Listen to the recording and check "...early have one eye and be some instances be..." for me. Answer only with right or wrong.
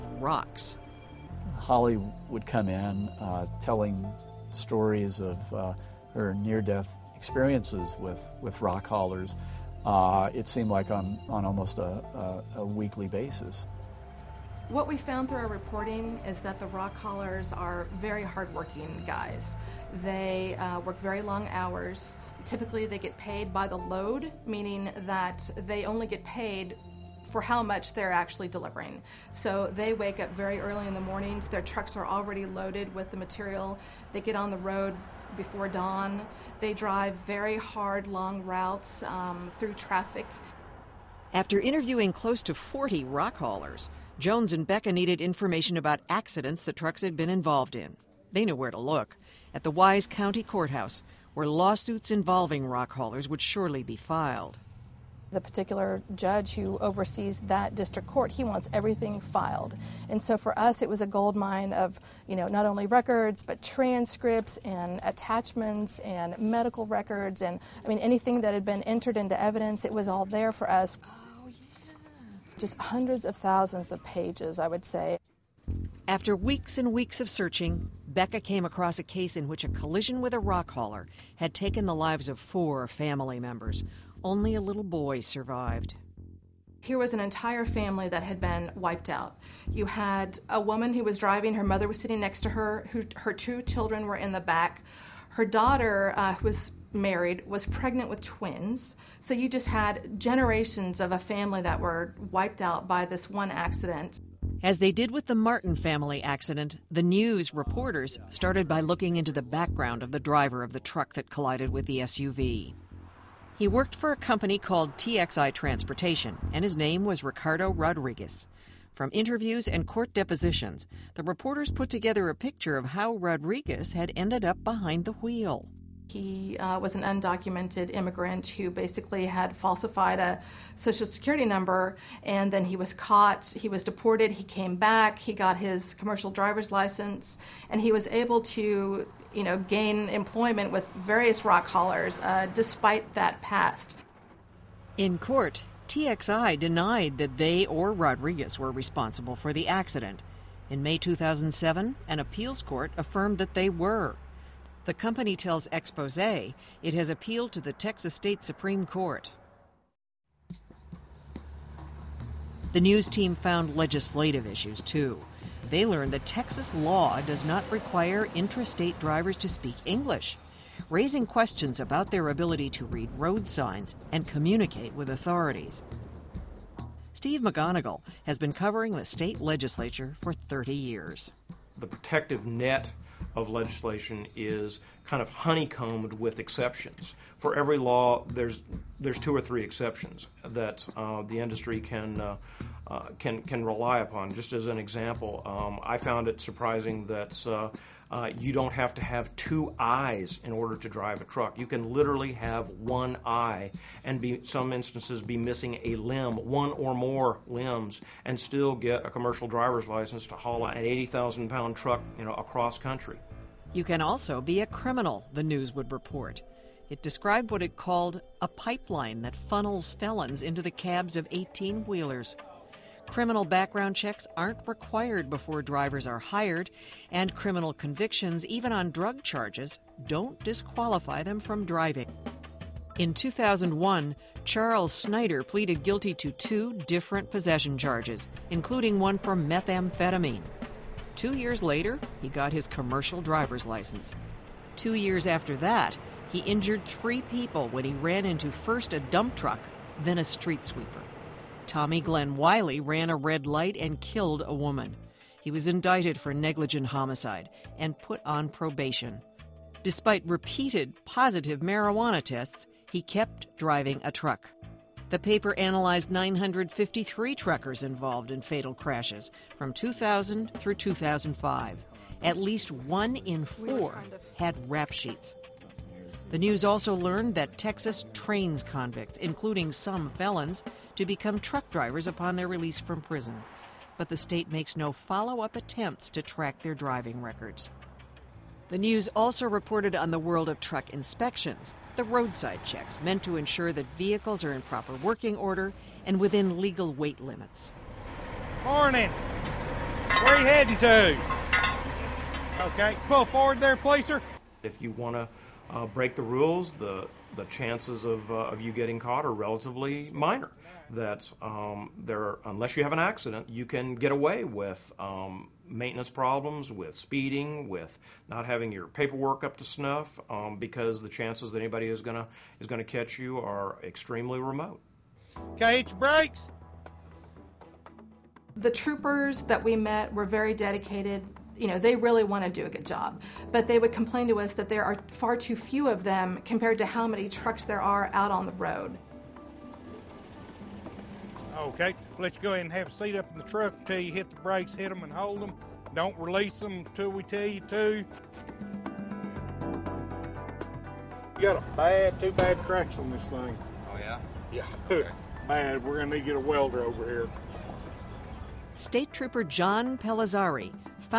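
wrong.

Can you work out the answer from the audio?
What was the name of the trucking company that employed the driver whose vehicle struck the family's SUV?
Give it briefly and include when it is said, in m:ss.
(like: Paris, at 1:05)
TXI Transportation, at 1:54.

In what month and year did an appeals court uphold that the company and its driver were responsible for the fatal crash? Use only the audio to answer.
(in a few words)
May 2007.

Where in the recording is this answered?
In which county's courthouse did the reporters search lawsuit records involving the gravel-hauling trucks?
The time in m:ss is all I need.
0:49.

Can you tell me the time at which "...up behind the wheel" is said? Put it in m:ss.
2:04.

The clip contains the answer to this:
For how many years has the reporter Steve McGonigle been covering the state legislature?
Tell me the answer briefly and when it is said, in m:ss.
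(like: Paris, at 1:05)
30 years, at 3:00.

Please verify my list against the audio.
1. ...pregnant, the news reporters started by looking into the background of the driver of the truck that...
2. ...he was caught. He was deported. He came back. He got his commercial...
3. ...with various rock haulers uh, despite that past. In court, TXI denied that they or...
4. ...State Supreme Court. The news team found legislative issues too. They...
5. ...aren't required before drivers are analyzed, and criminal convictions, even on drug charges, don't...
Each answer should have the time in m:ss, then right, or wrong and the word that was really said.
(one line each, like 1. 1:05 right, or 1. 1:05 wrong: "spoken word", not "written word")
1. 1:46 wrong: "accident", not "pregnant"
2. 2:12 right
3. 2:20 right
4. 2:38 right
5. 3:44 wrong: "hired", not "analyzed".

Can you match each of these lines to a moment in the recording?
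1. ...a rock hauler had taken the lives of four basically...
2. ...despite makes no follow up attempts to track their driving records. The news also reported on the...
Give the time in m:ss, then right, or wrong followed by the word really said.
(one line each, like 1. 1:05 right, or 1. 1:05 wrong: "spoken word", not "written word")
1. 1:20 wrong: "family", not "basically"
2. 4:44 wrong: "state", not "despite".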